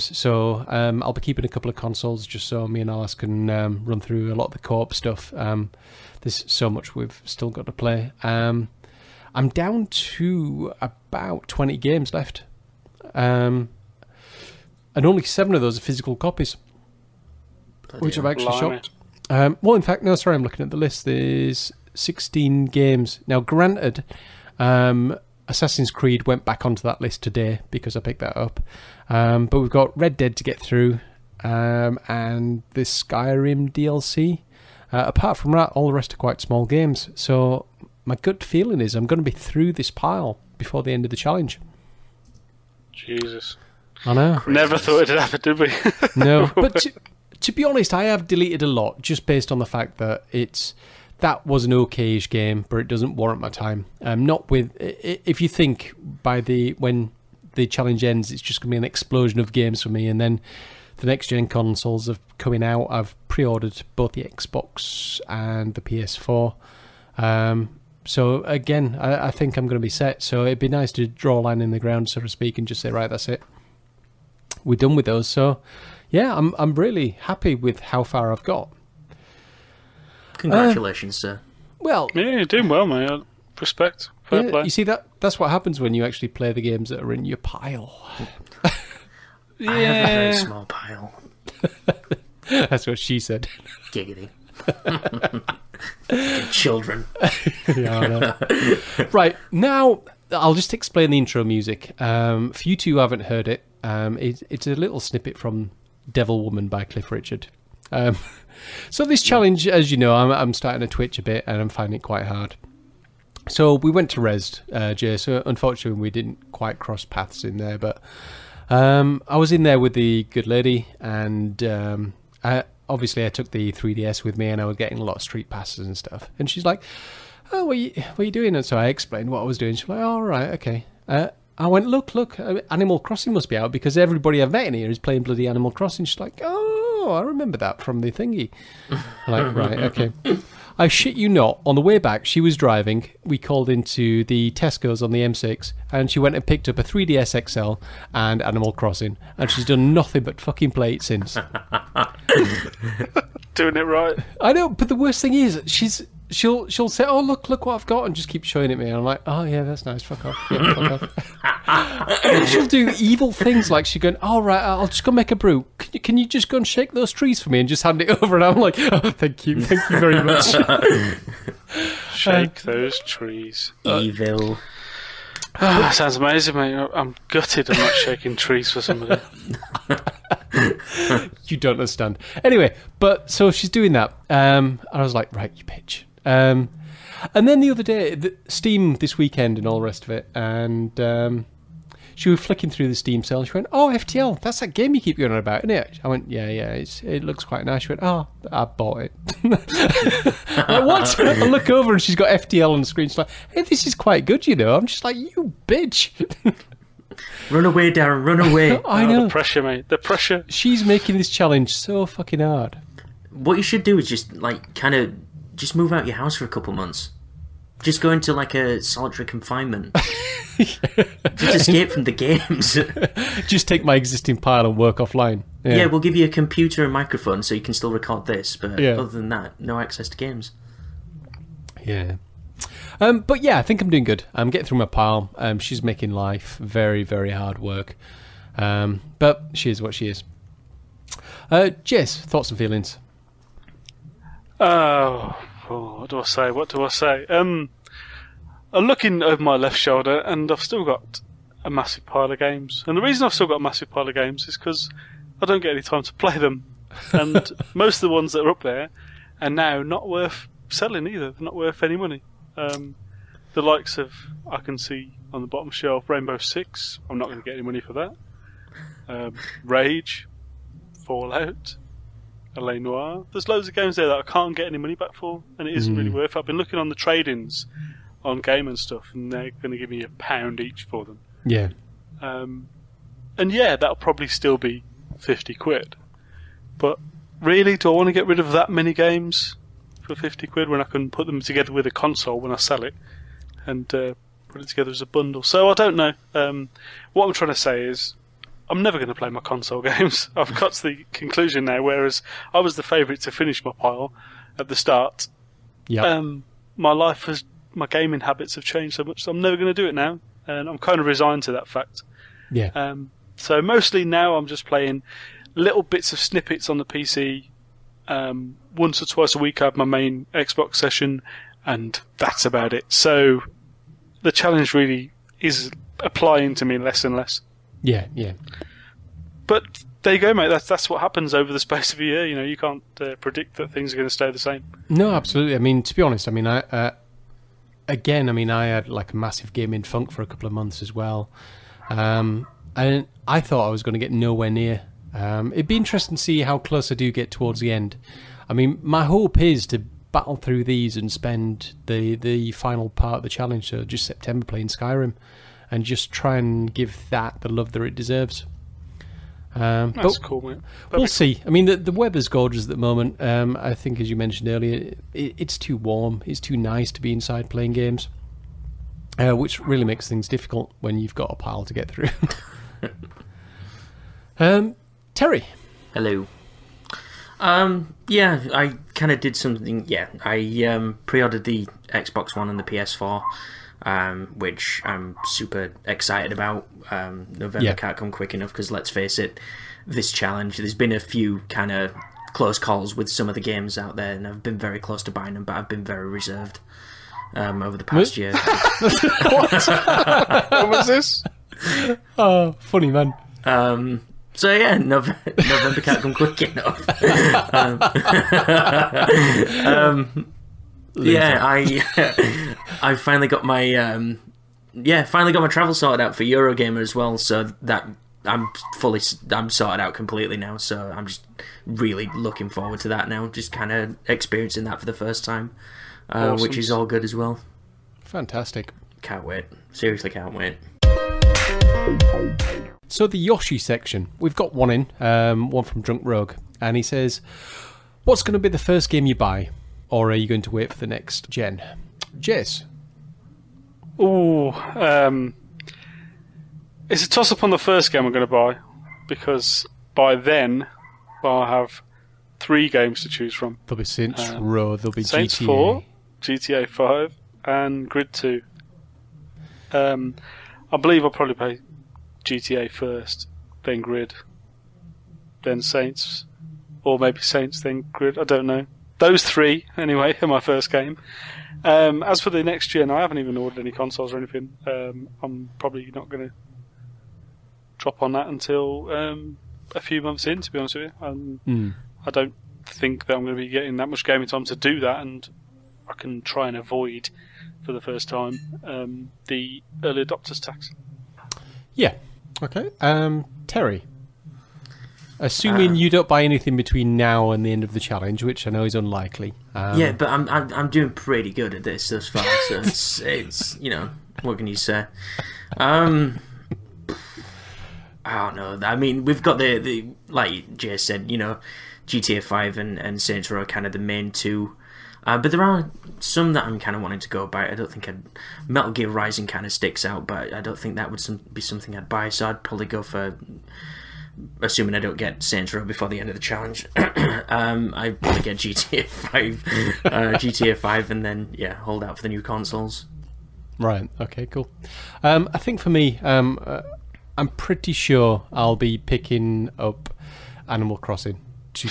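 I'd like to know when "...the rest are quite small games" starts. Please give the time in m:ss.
0:35.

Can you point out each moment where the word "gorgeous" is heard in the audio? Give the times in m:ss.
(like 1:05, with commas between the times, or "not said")
6:02.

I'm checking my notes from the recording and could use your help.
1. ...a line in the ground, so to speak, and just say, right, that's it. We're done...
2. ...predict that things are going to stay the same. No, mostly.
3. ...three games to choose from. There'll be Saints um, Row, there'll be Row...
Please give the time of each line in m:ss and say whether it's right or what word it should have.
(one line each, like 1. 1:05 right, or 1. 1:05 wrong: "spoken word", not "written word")
1. 1:11 right
2. 5:33 wrong: "absolutely", not "mostly"
3. 7:32 wrong: "Saints", not "Row".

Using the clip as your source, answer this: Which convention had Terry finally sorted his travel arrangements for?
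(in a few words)
Eurogamer.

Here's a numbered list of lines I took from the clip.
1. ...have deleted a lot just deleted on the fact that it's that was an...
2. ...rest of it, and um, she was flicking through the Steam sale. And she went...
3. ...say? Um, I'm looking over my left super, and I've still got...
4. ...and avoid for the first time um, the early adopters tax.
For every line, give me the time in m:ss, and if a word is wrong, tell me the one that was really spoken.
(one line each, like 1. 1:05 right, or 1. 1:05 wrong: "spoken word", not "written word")
1. 0:48 wrong: "based", not "deleted"
2. 3:09 right
3. 4:06 wrong: "shoulder", not "super"
4. 8:06 right.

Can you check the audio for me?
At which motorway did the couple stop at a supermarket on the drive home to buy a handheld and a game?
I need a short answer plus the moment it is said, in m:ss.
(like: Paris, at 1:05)
M6, at 2:25.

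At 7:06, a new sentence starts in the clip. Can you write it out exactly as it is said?
which is all good as well.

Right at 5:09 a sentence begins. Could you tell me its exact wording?
So I'm never going to do it now, and I'm kind of resigned to that fact.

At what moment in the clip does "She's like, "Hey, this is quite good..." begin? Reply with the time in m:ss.
3:23.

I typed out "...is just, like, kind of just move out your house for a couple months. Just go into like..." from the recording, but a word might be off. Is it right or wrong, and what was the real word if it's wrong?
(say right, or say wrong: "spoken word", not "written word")
right.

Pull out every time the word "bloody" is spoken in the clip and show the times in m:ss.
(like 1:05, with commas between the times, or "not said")
0:17, 2:15.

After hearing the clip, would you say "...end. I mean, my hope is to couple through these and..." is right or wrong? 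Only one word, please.
wrong.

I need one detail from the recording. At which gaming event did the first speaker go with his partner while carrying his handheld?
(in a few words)
Rezzed.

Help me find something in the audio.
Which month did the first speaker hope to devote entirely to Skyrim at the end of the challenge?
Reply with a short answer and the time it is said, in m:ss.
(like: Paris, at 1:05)
September, at 5:54.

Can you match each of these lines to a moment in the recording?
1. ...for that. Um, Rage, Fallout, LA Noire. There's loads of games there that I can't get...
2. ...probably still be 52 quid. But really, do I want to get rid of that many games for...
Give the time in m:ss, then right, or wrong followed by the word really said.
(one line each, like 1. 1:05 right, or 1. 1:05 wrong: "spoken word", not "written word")
1. 4:27 right
2. 4:43 wrong: "50", not "52".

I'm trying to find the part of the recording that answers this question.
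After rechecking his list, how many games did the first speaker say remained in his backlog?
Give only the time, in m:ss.
0:21.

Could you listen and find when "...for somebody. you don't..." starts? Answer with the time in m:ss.
2:58.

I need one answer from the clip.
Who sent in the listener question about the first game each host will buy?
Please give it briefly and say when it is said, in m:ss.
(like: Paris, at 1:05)
Drunk Rogue, at 7:15.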